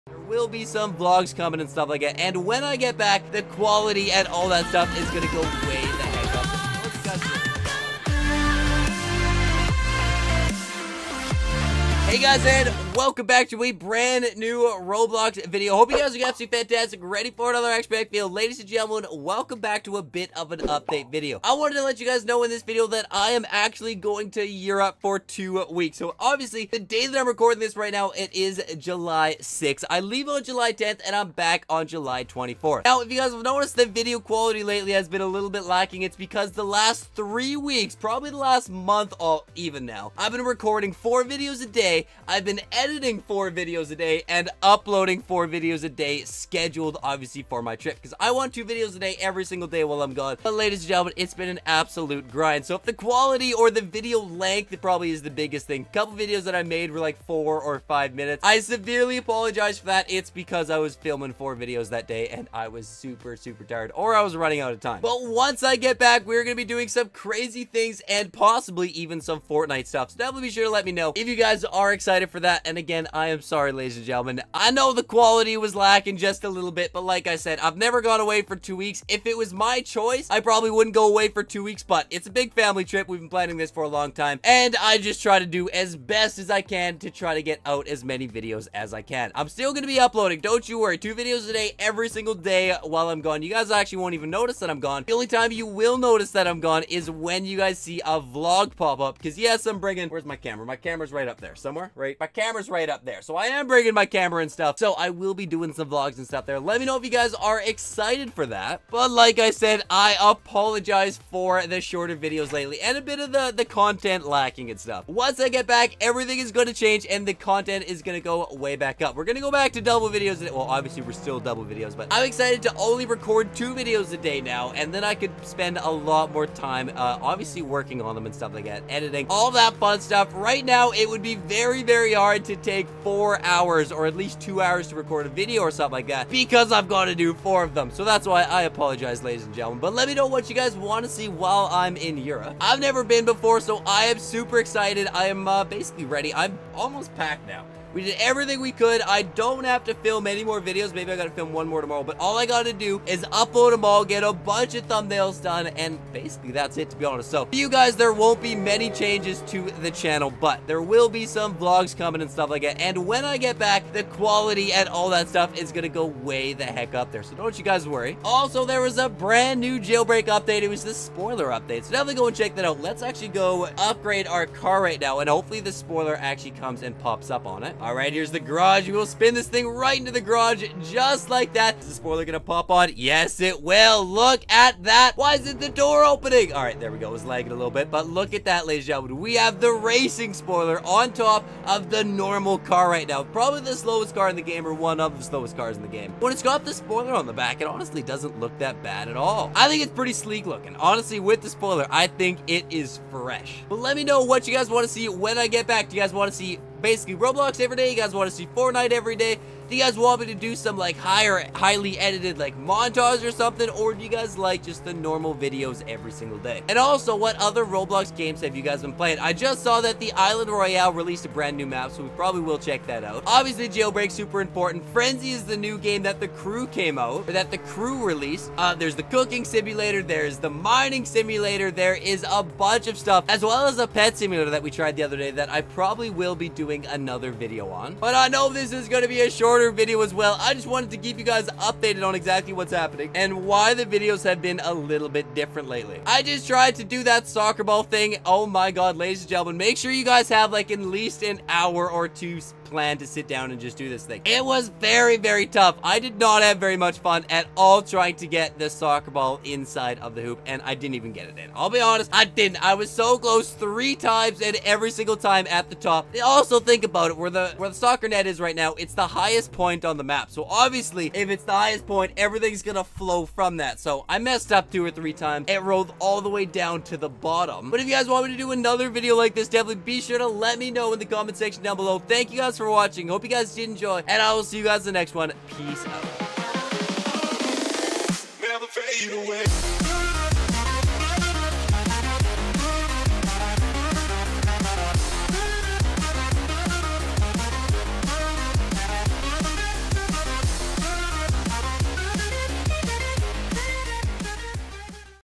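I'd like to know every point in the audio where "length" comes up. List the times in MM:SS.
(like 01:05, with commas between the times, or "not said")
00:54.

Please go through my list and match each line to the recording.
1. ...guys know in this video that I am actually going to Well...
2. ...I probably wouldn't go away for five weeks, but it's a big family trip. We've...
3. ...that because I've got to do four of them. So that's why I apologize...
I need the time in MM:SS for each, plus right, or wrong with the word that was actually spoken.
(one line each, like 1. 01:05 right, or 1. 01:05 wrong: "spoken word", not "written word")
1. 00:22 wrong: "Europe", not "Well"
2. 01:20 wrong: "two", not "five"
3. 02:16 right.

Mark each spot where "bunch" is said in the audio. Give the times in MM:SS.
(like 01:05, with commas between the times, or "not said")
02:34, 03:52.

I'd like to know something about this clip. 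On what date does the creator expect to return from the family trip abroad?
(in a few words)
July 24th.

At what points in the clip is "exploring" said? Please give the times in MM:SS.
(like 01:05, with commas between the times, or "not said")
not said.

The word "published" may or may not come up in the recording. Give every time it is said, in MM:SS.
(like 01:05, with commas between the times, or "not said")
not said.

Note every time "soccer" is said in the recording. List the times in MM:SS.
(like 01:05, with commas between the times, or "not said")
04:07, 04:18, 04:27.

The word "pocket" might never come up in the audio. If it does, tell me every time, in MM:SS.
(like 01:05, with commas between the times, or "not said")
not said.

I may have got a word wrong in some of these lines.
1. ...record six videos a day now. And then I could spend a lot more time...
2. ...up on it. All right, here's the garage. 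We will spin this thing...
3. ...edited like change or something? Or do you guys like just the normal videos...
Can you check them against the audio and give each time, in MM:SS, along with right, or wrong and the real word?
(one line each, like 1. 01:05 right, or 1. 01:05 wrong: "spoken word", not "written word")
1. 02:03 wrong: "two", not "six"
2. 02:57 right
3. 03:31 wrong: "montage", not "change".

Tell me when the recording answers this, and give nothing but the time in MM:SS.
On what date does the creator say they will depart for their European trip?
00:30.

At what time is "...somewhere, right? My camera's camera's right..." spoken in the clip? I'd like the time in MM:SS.
01:41.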